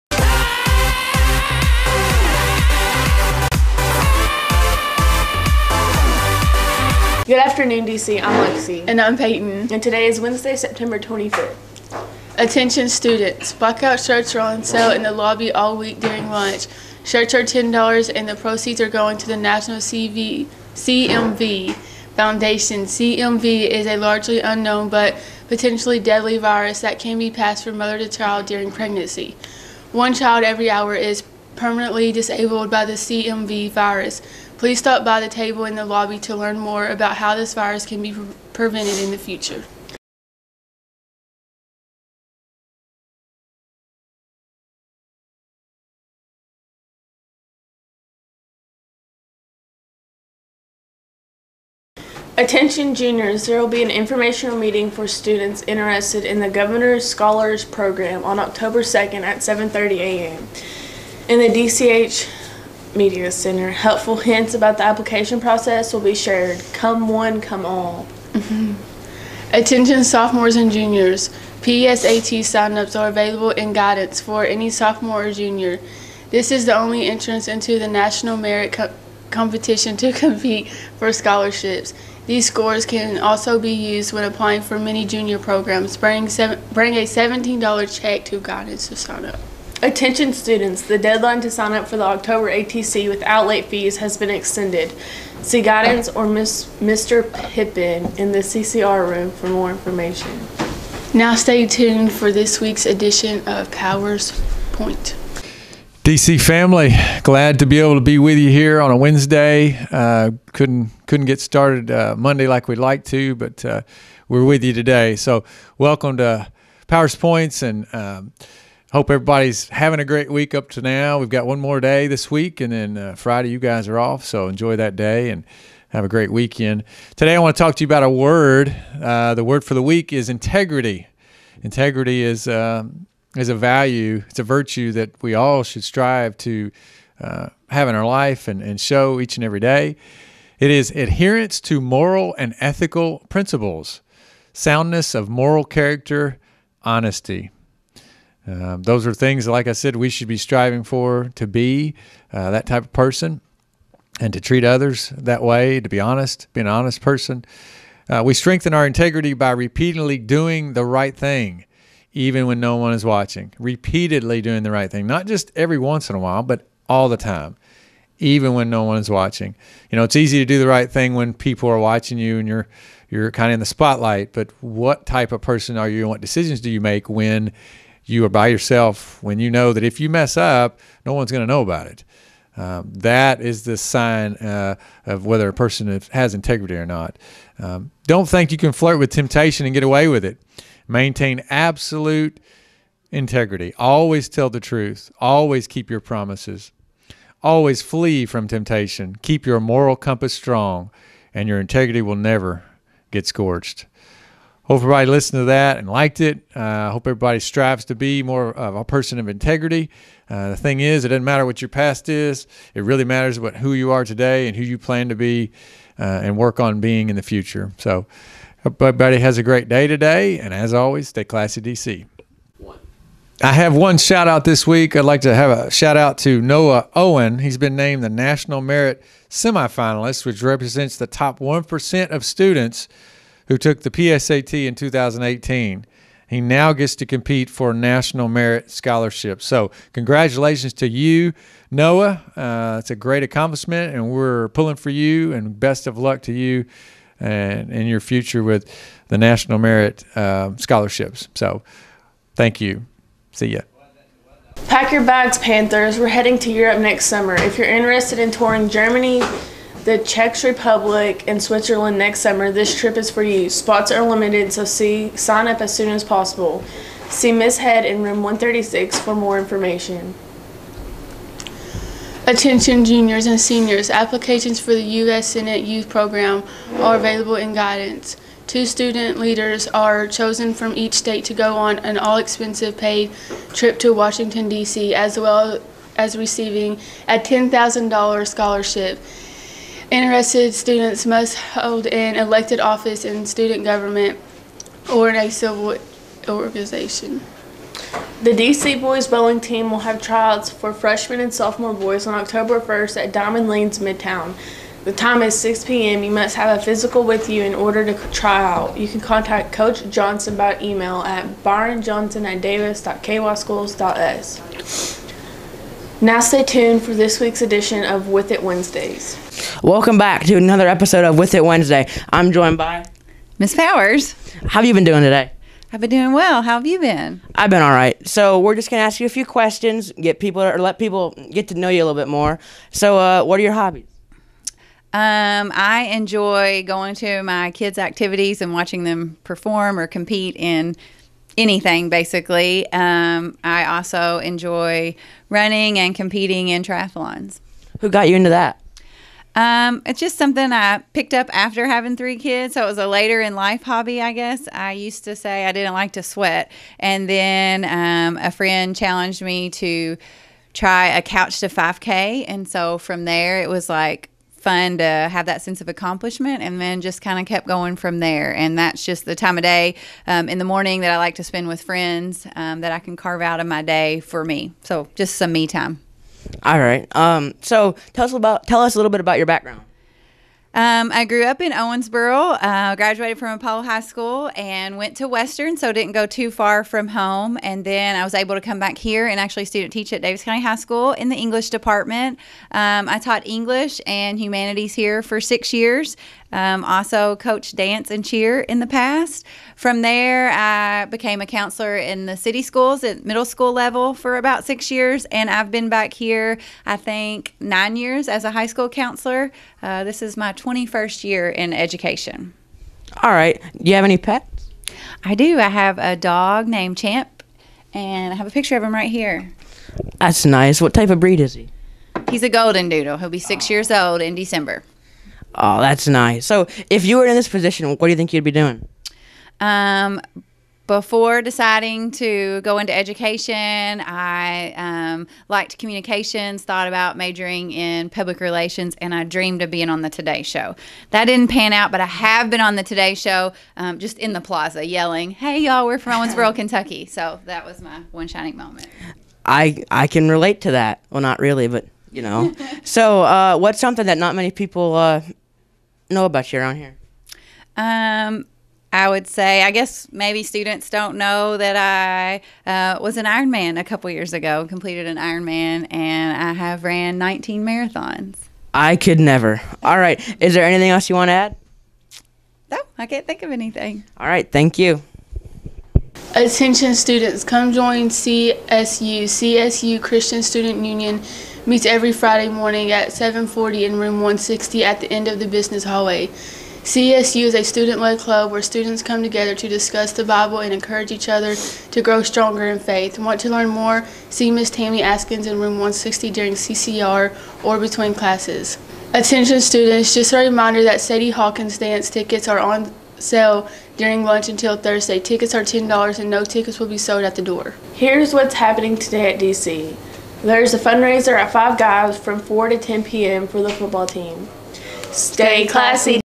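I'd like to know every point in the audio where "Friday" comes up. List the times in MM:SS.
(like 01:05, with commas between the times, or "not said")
02:03, 08:01.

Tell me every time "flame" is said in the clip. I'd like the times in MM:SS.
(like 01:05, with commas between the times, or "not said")
not said.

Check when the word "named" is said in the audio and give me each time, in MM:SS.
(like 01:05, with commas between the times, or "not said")
03:47, 06:56.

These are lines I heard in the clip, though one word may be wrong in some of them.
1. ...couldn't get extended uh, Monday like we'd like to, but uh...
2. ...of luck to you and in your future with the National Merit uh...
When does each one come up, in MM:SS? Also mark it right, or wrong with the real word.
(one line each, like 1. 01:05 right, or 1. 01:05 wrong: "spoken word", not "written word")
1. 01:51 wrong: "started", not "extended"
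2. 04:05 right.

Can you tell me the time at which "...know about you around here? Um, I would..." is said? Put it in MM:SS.
07:35.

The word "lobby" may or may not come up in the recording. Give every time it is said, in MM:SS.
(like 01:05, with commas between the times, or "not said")
00:15, 00:35.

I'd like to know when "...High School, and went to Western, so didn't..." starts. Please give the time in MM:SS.
06:23.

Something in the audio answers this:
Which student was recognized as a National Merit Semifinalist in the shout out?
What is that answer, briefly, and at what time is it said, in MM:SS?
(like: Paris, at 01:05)
Noah Owen, at 03:46.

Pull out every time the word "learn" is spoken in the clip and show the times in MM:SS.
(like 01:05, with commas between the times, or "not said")
00:36, 08:13.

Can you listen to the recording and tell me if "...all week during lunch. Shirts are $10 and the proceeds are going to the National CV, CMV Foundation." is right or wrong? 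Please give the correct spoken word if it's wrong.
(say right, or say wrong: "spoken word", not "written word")
right.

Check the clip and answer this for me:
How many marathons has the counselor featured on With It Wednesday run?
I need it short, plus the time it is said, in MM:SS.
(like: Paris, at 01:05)
19, at 07:46.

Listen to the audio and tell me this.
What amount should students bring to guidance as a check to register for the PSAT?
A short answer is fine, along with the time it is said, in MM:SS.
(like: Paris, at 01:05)
$17, at 01:27.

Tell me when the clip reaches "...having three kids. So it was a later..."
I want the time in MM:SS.
05:51.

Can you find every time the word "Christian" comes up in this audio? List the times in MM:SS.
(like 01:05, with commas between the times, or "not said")
07:59.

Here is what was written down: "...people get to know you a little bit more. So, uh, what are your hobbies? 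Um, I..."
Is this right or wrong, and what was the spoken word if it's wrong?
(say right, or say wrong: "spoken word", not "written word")
right.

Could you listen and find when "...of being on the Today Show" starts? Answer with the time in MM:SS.
07:19.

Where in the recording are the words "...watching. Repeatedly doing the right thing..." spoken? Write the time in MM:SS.
02:43.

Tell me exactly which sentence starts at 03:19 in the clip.
Keep your moral compass strong, and your integrity will never get scorched.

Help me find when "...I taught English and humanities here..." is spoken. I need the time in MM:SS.
06:32.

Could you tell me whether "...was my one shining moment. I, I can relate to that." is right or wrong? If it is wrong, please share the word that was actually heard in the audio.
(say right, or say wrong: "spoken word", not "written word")
right.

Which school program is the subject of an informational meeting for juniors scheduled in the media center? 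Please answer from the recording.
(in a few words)
Governor's Scholars Program.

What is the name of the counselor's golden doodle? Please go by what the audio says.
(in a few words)
Champ.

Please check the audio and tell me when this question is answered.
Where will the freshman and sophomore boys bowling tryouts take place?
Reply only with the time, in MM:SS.
05:03.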